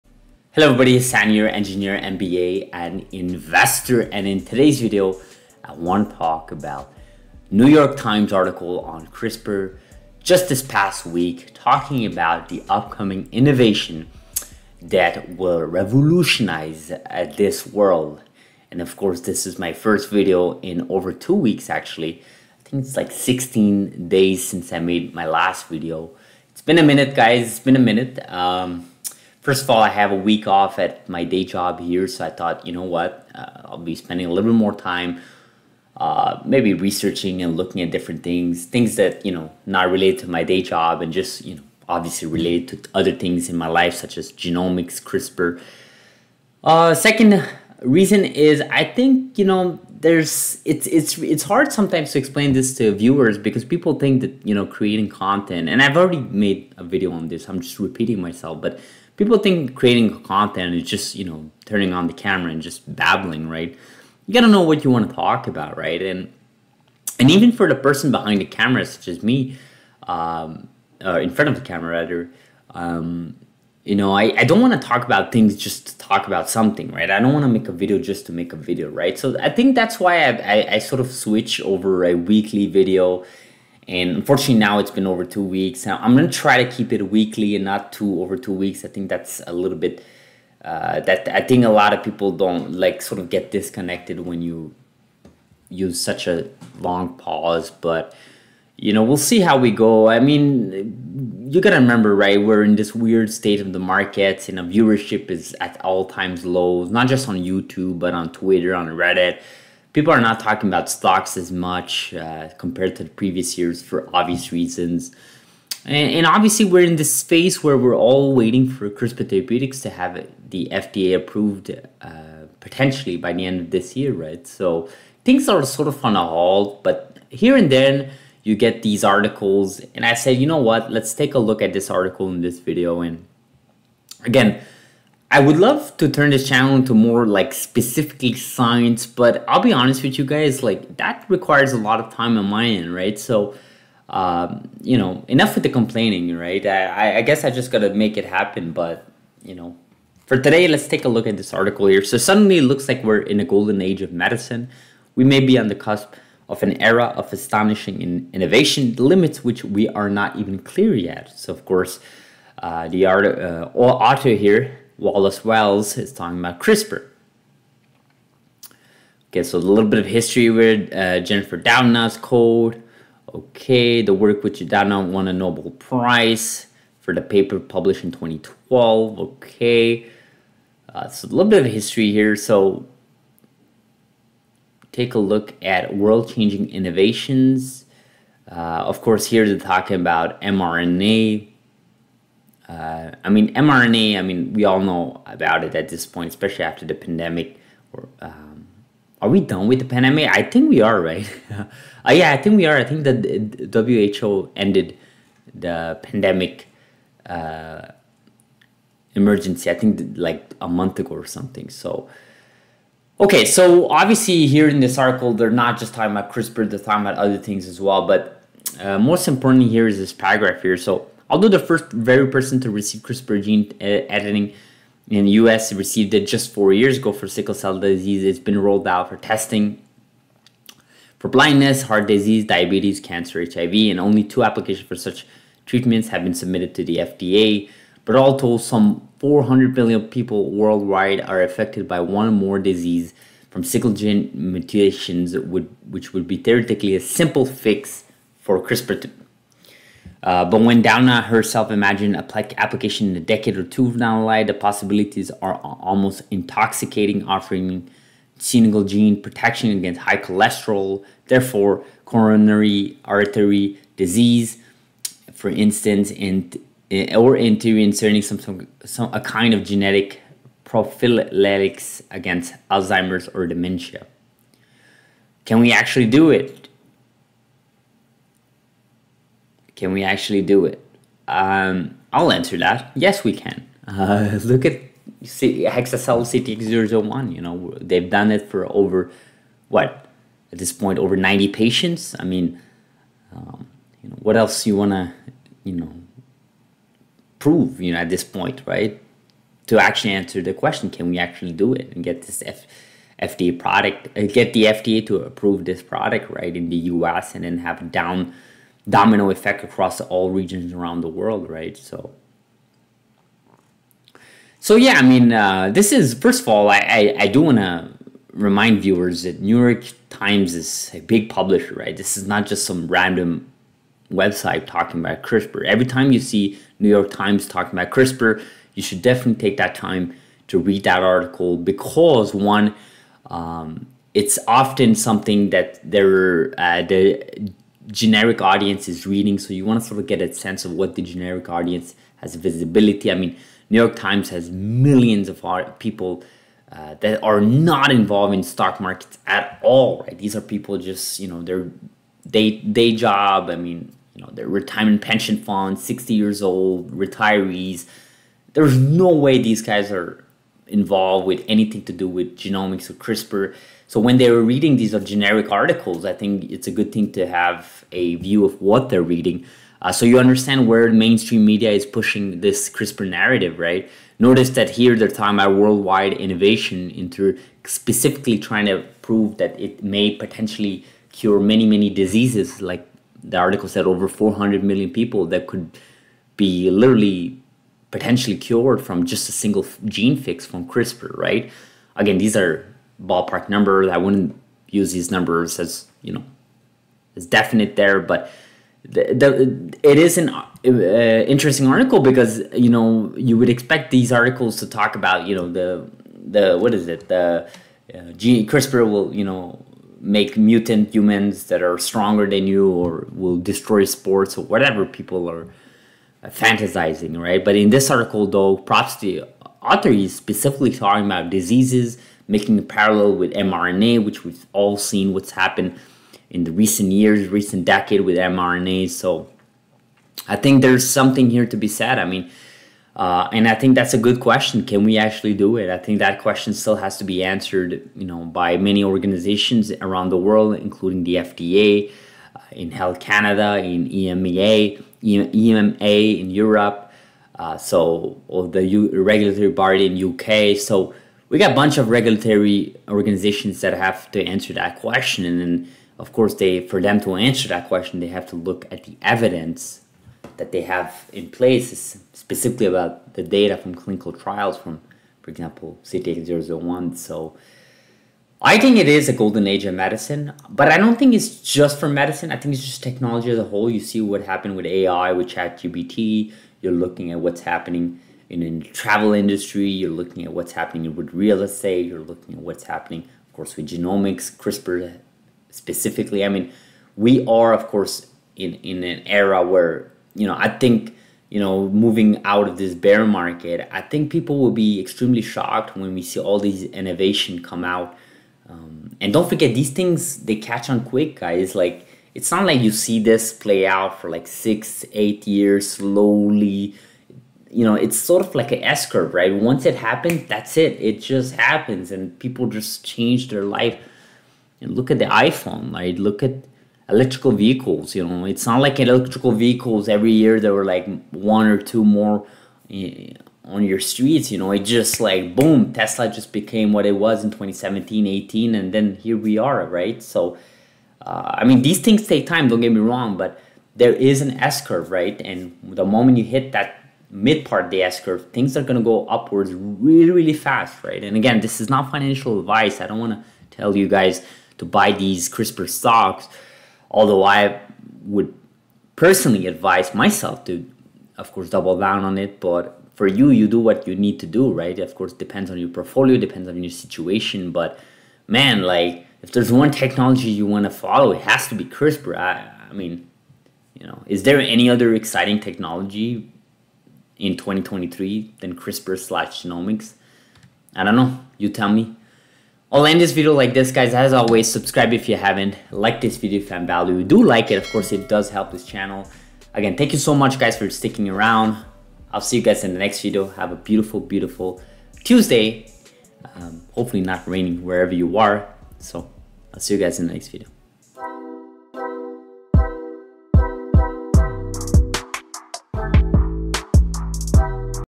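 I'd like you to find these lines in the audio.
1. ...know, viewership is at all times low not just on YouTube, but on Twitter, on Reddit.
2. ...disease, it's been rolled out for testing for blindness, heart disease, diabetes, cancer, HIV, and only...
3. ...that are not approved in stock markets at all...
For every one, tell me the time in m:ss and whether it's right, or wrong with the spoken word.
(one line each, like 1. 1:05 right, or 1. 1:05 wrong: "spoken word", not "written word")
1. 1:44 right
2. 3:47 right
3. 5:47 wrong: "involved", not "approved".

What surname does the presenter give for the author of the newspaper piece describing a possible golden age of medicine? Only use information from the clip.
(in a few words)
Wallace Wells.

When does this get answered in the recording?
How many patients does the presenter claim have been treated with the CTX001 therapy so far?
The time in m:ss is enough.
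4:50.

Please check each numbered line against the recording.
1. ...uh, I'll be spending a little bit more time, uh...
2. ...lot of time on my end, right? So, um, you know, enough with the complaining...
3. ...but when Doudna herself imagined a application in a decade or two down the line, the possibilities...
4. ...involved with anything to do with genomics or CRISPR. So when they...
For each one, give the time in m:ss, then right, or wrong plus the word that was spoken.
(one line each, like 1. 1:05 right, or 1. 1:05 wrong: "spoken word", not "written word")
1. 0:33 right
2. 2:21 right
3. 4:10 right
4. 6:00 right.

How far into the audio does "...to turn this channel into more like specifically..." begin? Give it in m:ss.
2:15.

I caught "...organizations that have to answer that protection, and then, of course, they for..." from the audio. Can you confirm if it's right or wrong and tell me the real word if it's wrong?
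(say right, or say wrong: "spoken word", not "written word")
wrong: "question", not "protection".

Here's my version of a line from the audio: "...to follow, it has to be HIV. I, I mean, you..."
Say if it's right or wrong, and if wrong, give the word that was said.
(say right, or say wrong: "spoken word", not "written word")
wrong: "CRISPR", not "HIV".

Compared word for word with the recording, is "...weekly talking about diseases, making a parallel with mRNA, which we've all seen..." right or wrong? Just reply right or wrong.
wrong.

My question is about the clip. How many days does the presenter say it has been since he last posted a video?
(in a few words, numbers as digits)
16.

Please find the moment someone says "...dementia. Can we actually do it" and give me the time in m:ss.
4:33.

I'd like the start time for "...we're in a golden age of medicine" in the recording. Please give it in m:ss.
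2:33.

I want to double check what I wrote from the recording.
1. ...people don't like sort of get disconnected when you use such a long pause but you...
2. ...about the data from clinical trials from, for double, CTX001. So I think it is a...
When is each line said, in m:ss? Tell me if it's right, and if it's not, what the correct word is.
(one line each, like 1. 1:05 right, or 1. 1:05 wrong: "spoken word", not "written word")
1. 1:32 right
2. 7:42 wrong: "example", not "double".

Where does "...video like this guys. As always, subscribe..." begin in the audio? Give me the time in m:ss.
9:33.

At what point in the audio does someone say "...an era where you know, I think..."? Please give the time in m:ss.
8:08.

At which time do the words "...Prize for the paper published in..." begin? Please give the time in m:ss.
2:55.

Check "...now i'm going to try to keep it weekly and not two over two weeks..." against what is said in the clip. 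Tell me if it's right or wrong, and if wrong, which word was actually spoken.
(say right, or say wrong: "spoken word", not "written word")
right.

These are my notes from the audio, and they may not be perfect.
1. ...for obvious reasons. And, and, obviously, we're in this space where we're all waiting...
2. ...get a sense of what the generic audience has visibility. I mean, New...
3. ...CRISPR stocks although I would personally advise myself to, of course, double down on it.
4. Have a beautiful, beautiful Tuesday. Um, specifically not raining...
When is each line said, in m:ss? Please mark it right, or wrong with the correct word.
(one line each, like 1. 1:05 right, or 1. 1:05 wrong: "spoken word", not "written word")
1. 1:53 right
2. 5:40 right
3. 9:05 right
4. 9:43 wrong: "hopefully", not "specifically".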